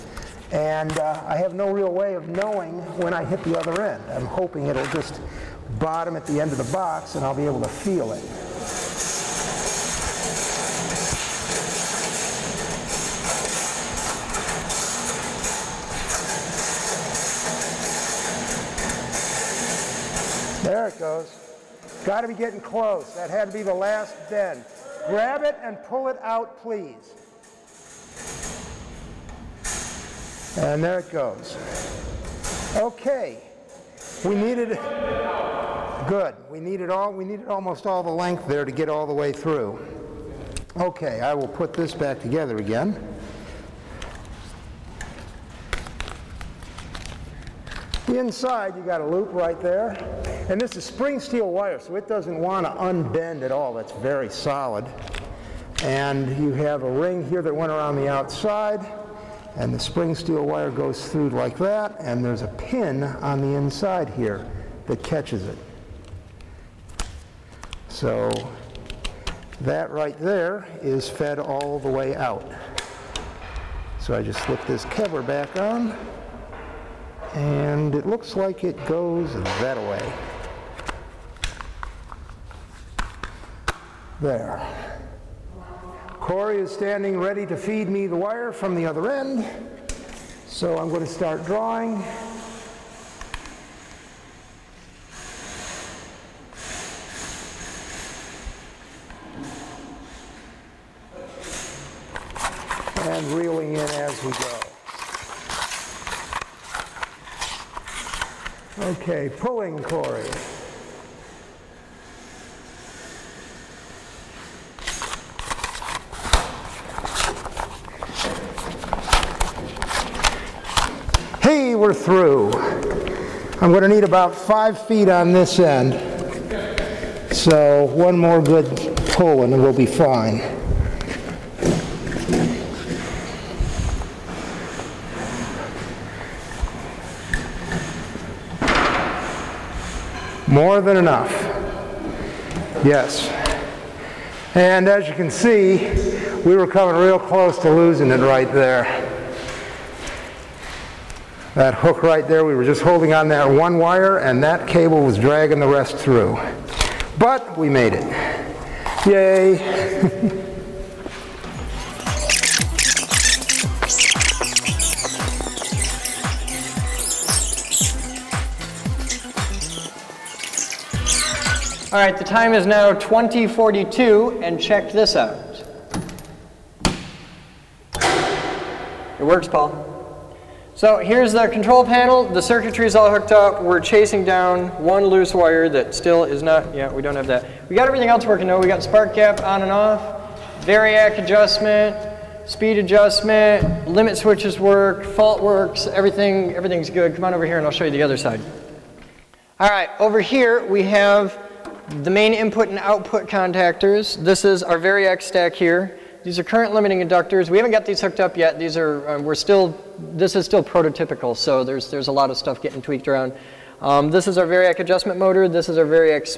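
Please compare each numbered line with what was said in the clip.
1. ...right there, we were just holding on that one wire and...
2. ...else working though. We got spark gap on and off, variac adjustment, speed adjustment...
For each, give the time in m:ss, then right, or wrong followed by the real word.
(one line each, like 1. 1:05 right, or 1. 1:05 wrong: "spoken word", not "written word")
1. 2:32 right
2. 3:08 right.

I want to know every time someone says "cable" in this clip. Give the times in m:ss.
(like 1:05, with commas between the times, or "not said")
2:34.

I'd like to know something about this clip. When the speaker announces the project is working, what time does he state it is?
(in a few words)
2042.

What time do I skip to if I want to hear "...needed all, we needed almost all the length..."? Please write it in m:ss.
0:36.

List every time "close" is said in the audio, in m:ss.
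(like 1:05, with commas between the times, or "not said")
0:22, 2:27.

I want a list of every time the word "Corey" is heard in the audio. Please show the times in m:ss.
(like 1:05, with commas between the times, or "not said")
1:26, 1:49.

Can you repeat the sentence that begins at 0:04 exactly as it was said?
I'm hoping it'll just bottom at the end of the box and I'll be able to feel it.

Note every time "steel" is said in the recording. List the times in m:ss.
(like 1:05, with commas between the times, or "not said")
0:51, 1:00.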